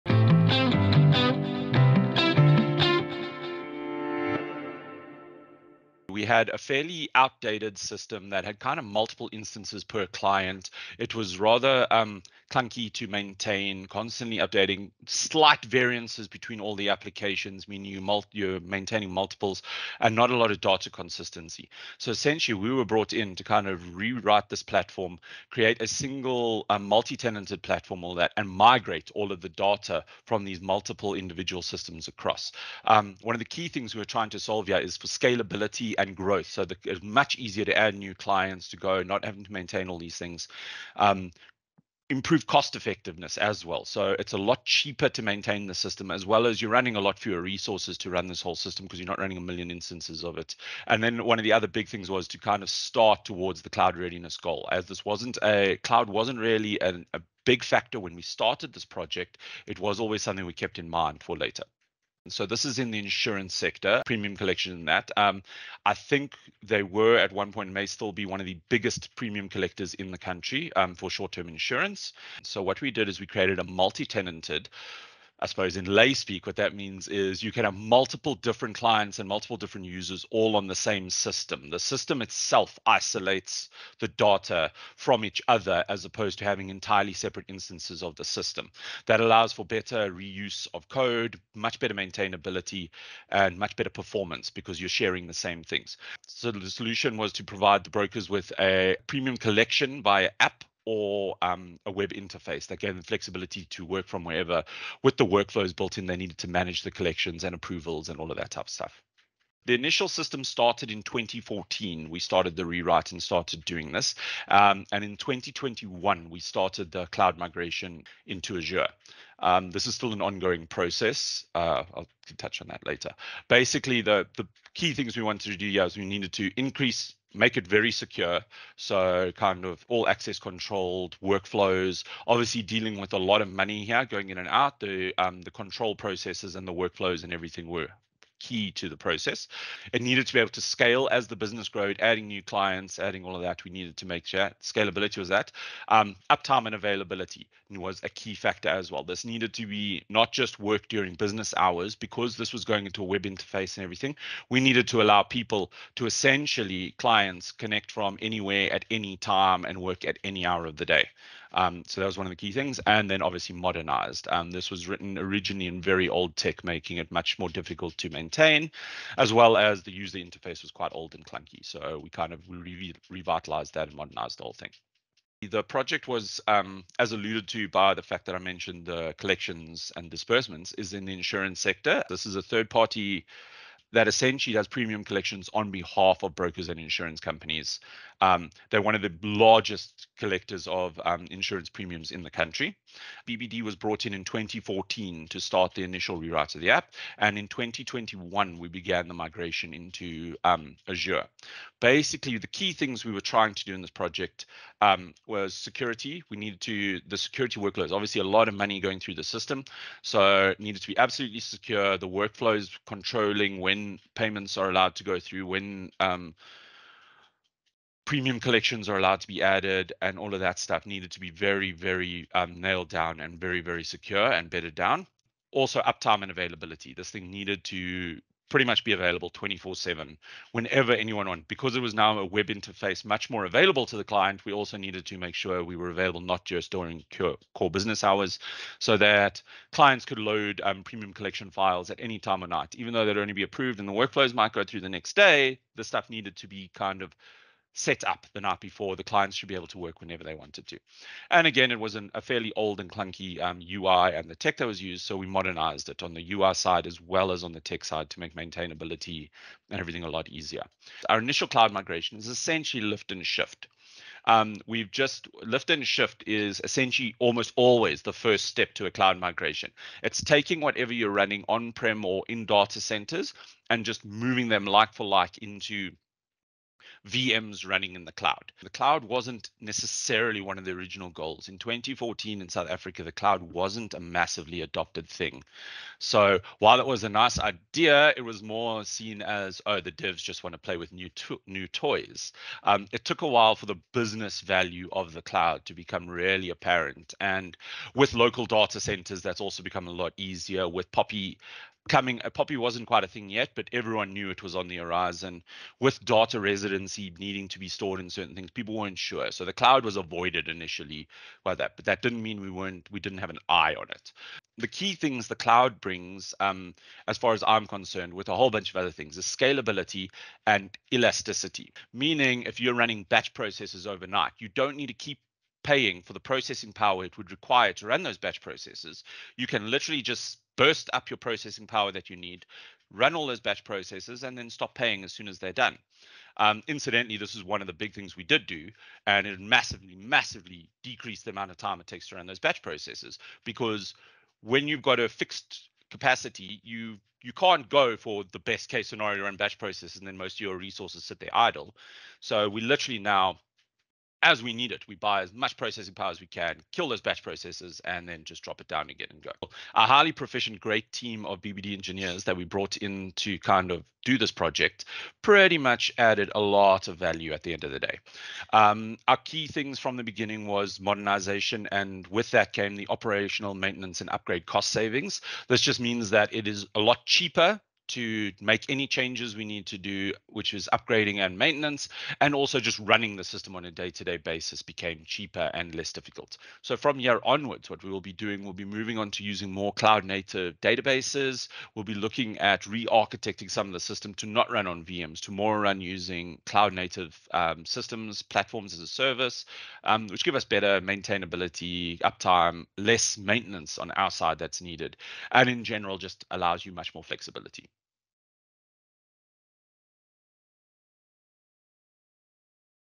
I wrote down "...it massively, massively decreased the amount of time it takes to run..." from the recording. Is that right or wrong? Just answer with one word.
right.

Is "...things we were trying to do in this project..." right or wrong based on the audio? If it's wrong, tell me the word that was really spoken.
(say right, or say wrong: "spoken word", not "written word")
right.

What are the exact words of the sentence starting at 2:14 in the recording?
The um, the control processes and the workflows and everything were key to the process.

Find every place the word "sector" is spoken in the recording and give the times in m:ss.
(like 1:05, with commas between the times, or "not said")
1:03, 3:01.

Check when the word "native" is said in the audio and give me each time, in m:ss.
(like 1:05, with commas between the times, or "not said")
6:29, 6:36.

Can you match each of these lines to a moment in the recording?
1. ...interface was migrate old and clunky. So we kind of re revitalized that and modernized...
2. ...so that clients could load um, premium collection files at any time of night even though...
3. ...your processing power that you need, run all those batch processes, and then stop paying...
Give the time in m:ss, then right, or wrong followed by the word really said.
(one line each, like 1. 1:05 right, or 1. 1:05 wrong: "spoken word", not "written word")
1. 2:50 wrong: "quite", not "migrate"
2. 3:58 right
3. 5:31 right.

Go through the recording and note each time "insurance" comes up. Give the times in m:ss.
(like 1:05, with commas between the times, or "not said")
1:02, 1:11, 3:01, 3:06, 3:11.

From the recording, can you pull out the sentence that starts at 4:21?
Our initial cloud migration is essentially lift and shift.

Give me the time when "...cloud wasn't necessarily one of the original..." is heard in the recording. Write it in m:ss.
4:38.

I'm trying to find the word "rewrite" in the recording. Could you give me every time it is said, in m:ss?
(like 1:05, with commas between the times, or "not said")
0:23, 1:52, 3:16.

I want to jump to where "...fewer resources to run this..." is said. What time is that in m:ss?
0:47.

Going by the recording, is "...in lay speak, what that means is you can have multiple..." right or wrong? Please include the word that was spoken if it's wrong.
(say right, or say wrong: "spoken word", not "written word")
right.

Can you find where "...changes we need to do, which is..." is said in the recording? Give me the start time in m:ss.
6:18.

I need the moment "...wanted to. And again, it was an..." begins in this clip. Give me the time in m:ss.
4:10.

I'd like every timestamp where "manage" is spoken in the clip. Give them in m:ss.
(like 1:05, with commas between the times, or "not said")
1:46.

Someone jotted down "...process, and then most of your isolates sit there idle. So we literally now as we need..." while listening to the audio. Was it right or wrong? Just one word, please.
wrong.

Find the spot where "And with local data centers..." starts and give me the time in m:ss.
4:57.